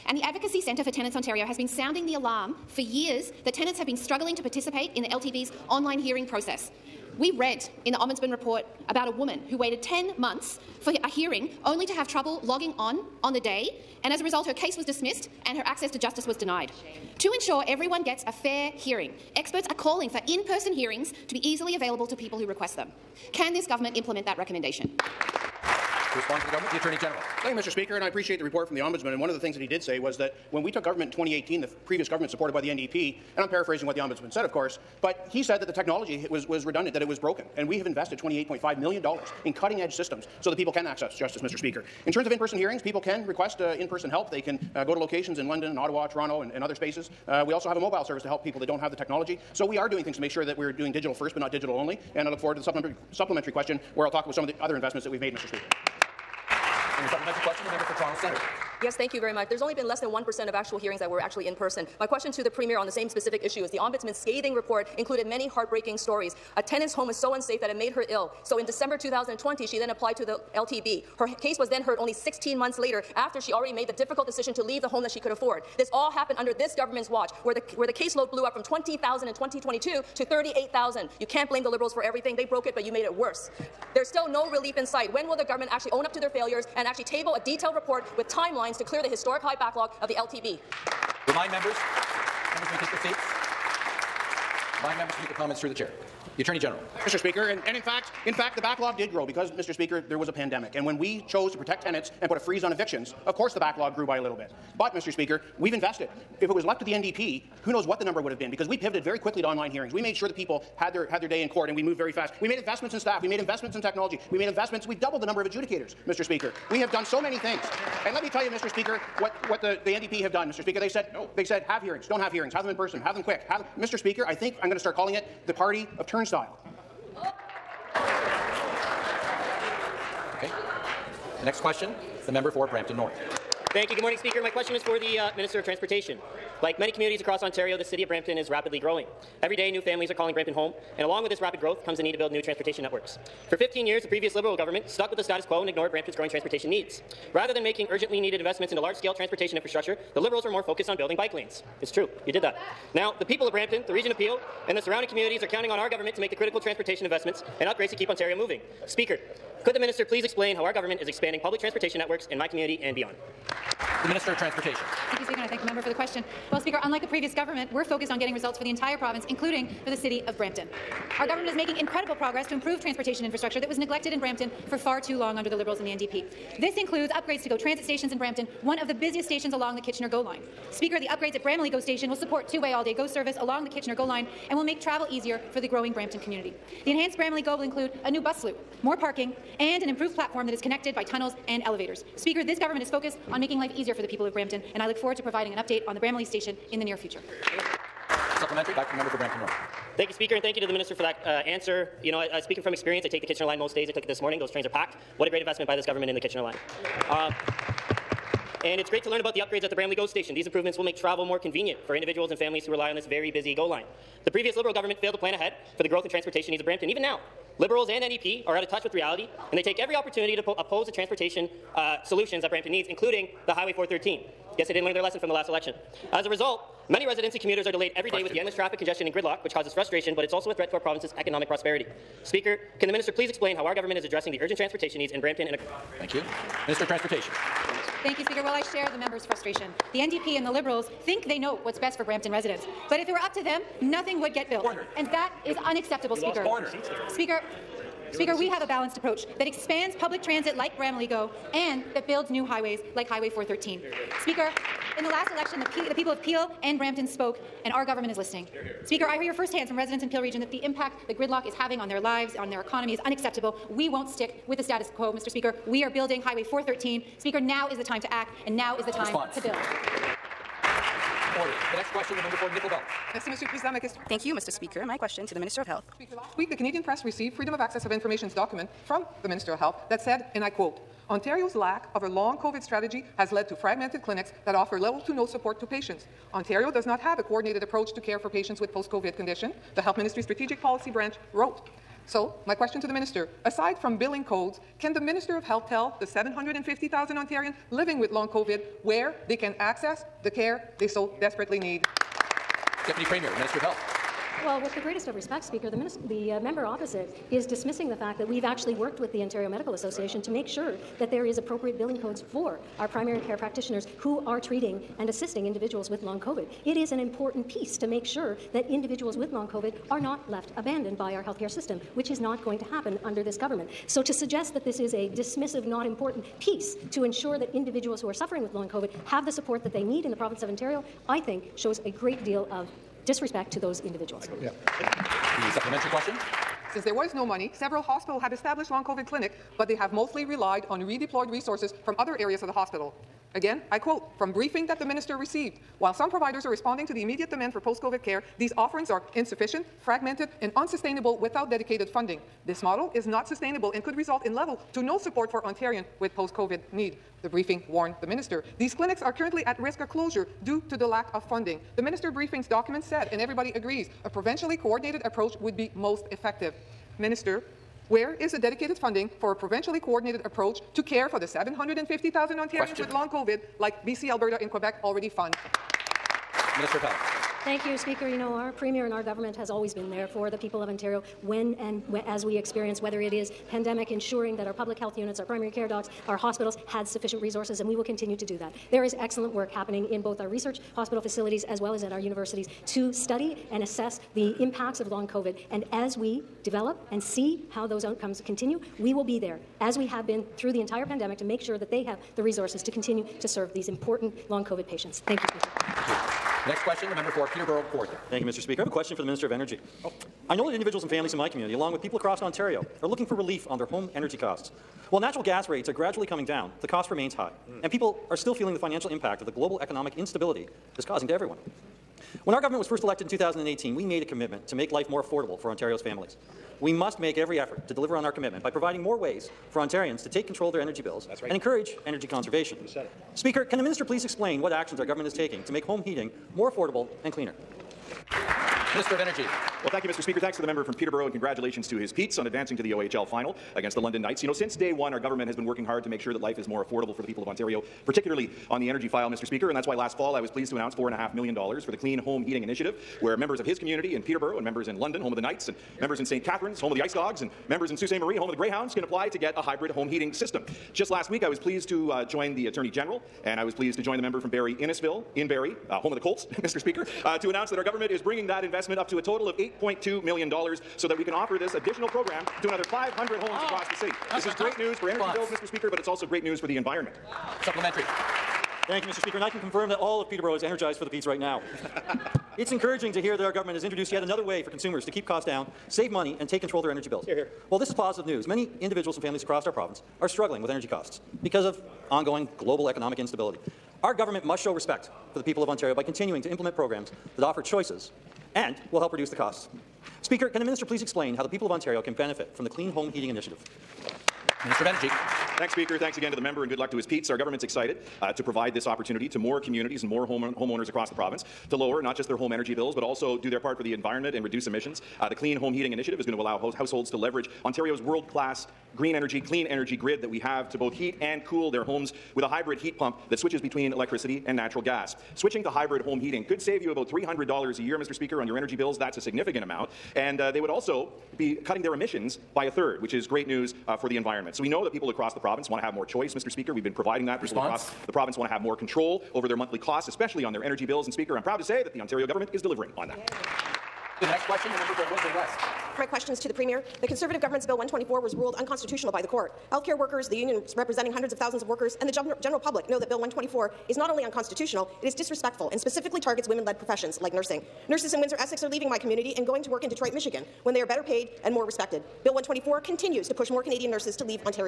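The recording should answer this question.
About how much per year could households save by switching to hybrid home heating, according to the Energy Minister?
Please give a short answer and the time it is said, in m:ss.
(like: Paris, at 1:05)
$300, at 8:46.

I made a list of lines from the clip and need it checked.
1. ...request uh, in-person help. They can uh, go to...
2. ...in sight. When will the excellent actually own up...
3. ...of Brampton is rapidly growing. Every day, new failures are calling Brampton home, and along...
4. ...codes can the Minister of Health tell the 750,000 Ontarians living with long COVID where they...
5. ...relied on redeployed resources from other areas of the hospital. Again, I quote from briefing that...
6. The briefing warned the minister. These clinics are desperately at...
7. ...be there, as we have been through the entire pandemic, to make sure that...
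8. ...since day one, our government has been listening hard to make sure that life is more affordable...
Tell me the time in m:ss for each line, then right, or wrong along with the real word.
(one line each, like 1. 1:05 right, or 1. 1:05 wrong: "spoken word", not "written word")
1. 0:43 right
2. 1:24 wrong: "government", not "excellent"
3. 2:18 wrong: "families", not "failures"
4. 4:54 right
5. 5:40 right
6. 5:57 wrong: "currently", not "desperately"
7. 6:39 right
8. 7:24 wrong: "working", not "listening".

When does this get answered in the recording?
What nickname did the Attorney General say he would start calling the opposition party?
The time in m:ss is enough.
2:05.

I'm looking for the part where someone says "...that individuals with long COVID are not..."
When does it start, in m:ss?
5:18.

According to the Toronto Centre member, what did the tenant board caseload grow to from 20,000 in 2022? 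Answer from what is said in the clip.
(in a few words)
38,000.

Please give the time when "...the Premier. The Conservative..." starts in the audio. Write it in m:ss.
9:06.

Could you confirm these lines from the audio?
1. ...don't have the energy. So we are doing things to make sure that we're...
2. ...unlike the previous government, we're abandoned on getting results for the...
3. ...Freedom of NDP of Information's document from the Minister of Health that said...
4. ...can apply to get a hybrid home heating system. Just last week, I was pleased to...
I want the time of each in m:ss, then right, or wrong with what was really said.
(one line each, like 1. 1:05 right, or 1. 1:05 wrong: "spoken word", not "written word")
1. 0:48 wrong: "technology", not "energy"
2. 2:46 wrong: "focused", not "abandoned"
3. 4:37 wrong: "Access", not "NDP"
4. 7:38 right.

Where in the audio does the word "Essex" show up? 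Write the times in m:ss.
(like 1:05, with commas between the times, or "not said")
9:18.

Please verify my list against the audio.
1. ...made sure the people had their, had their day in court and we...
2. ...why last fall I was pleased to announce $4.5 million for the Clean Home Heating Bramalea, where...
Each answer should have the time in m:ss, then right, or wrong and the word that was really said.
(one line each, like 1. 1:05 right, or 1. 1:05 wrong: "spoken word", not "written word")
1. 1:50 right
2. 7:29 wrong: "Initiative", not "Bramalea".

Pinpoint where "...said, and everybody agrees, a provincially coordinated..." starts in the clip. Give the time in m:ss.
6:02.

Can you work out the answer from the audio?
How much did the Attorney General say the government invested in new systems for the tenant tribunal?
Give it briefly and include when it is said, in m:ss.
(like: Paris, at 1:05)
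$28.5 million, at 0:38.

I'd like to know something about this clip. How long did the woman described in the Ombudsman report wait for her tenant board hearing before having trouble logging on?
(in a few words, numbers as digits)
10 months.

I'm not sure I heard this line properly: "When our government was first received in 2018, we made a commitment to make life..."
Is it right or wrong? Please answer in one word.
wrong.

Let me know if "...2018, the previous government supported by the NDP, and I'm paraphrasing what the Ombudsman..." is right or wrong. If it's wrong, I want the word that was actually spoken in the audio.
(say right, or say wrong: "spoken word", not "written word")
right.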